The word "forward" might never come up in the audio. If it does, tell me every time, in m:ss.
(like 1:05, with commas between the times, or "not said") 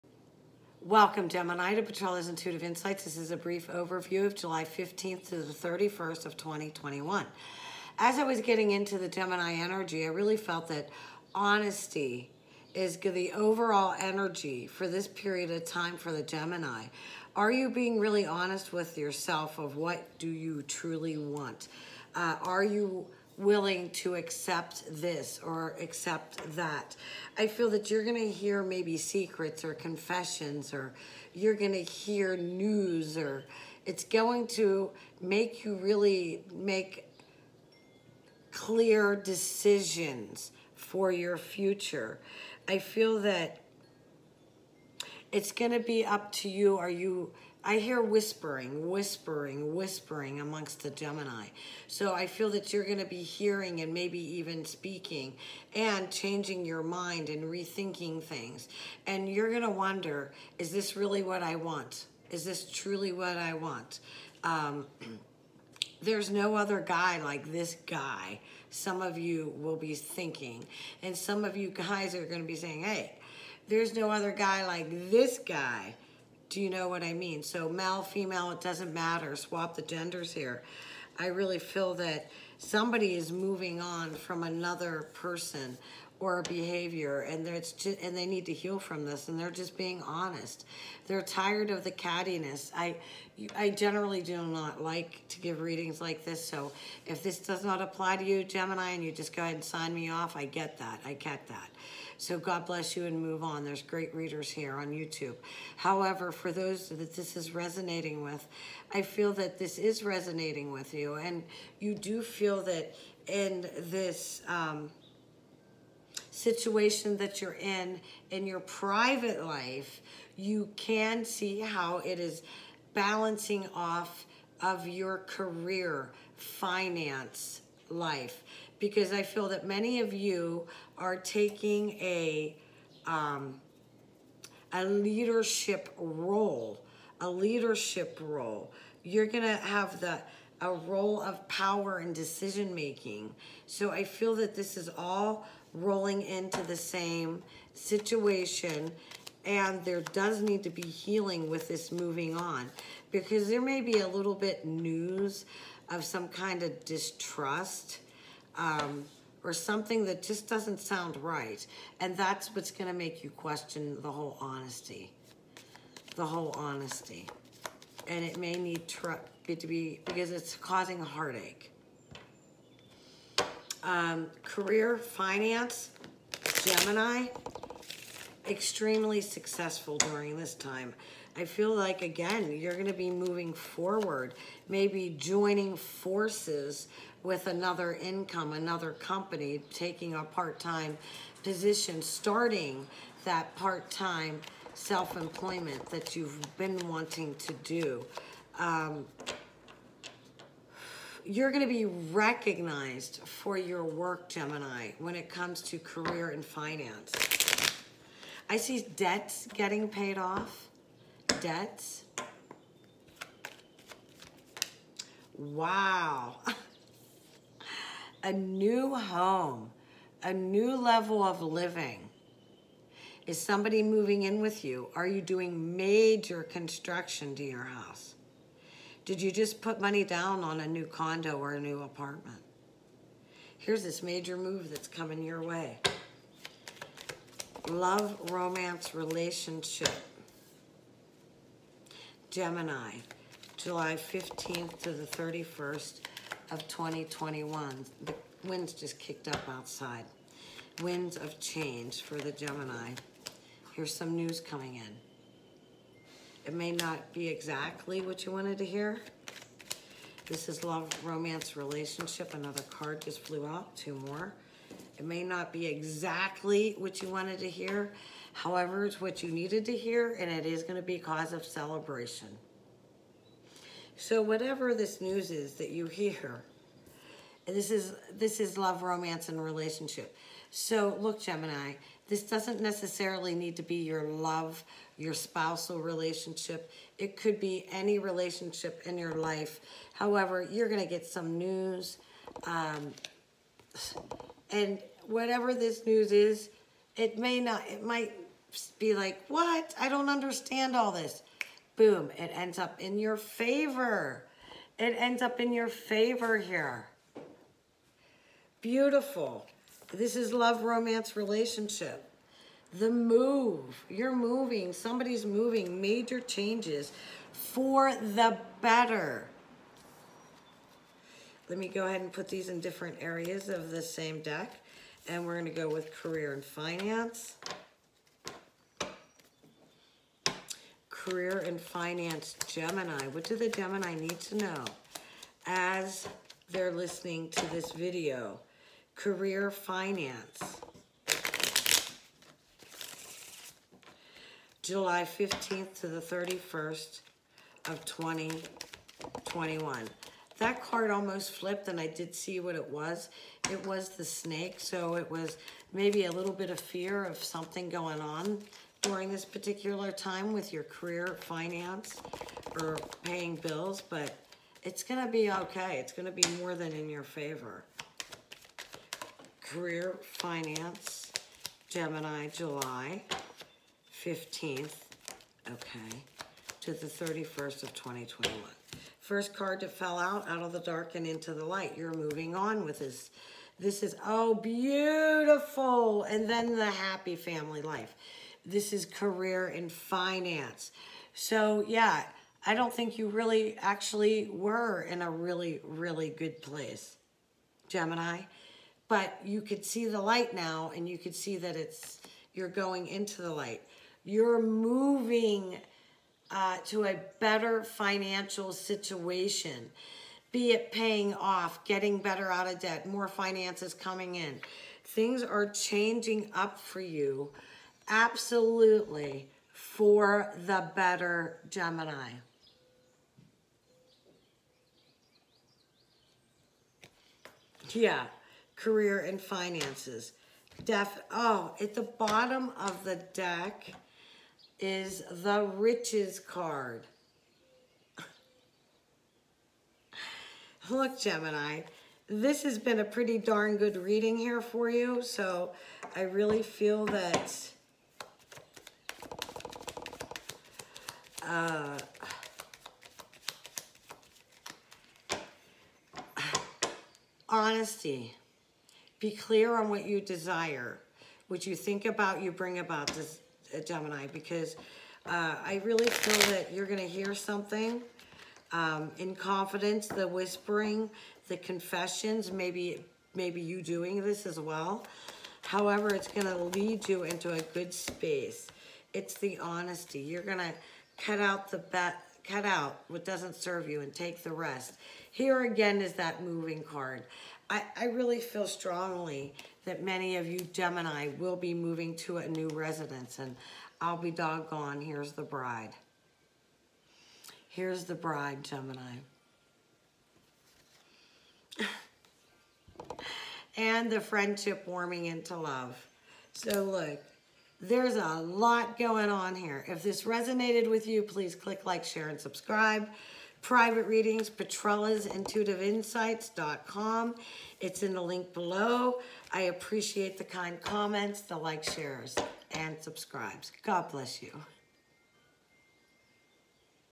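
3:03.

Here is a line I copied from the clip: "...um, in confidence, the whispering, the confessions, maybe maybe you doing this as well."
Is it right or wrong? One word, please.
right.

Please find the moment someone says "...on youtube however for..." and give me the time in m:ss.
1:44.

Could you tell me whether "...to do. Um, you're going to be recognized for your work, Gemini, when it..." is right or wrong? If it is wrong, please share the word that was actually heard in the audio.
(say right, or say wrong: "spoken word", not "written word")
right.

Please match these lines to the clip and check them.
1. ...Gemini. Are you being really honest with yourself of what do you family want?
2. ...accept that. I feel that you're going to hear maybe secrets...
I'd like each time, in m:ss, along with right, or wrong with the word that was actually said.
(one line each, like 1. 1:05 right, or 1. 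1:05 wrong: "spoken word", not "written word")
1. 0:16 wrong: "truly", not "family"
2. 0:25 right.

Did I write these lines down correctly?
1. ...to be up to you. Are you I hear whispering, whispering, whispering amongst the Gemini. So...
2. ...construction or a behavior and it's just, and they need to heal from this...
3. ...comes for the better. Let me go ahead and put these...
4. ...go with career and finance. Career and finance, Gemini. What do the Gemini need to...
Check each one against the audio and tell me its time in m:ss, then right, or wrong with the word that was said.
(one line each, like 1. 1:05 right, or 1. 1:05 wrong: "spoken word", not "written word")
1. 0:45 right
2. 1:25 wrong: "person", not "construction"
3. 5:16 wrong: "changes", not "comes"
4. 5:25 right.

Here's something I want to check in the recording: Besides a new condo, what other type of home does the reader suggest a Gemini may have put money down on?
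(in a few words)
A new apartment.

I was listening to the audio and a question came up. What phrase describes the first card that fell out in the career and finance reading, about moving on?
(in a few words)
Out of the dark and into the light.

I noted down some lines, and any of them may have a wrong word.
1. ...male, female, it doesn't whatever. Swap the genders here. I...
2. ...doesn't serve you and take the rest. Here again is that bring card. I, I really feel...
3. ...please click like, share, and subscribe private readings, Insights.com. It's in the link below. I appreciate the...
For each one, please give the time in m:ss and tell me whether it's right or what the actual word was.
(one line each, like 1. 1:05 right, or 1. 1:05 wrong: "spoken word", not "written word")
1. 1:17 wrong: "matter", not "whatever"
2. 8:03 wrong: "moving", not "bring"
3. 8:31 right.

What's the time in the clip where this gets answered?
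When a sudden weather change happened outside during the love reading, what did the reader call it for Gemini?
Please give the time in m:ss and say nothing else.
4:10.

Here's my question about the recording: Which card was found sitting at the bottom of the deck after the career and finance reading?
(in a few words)
The riches card.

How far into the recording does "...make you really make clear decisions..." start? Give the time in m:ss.
0:35.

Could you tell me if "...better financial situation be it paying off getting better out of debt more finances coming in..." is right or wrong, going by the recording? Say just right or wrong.
right.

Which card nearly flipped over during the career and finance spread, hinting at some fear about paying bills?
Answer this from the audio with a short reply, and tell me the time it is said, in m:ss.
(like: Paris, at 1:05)
The snake, at 5:53.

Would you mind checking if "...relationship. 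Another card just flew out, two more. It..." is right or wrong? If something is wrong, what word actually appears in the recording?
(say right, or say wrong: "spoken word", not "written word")
right.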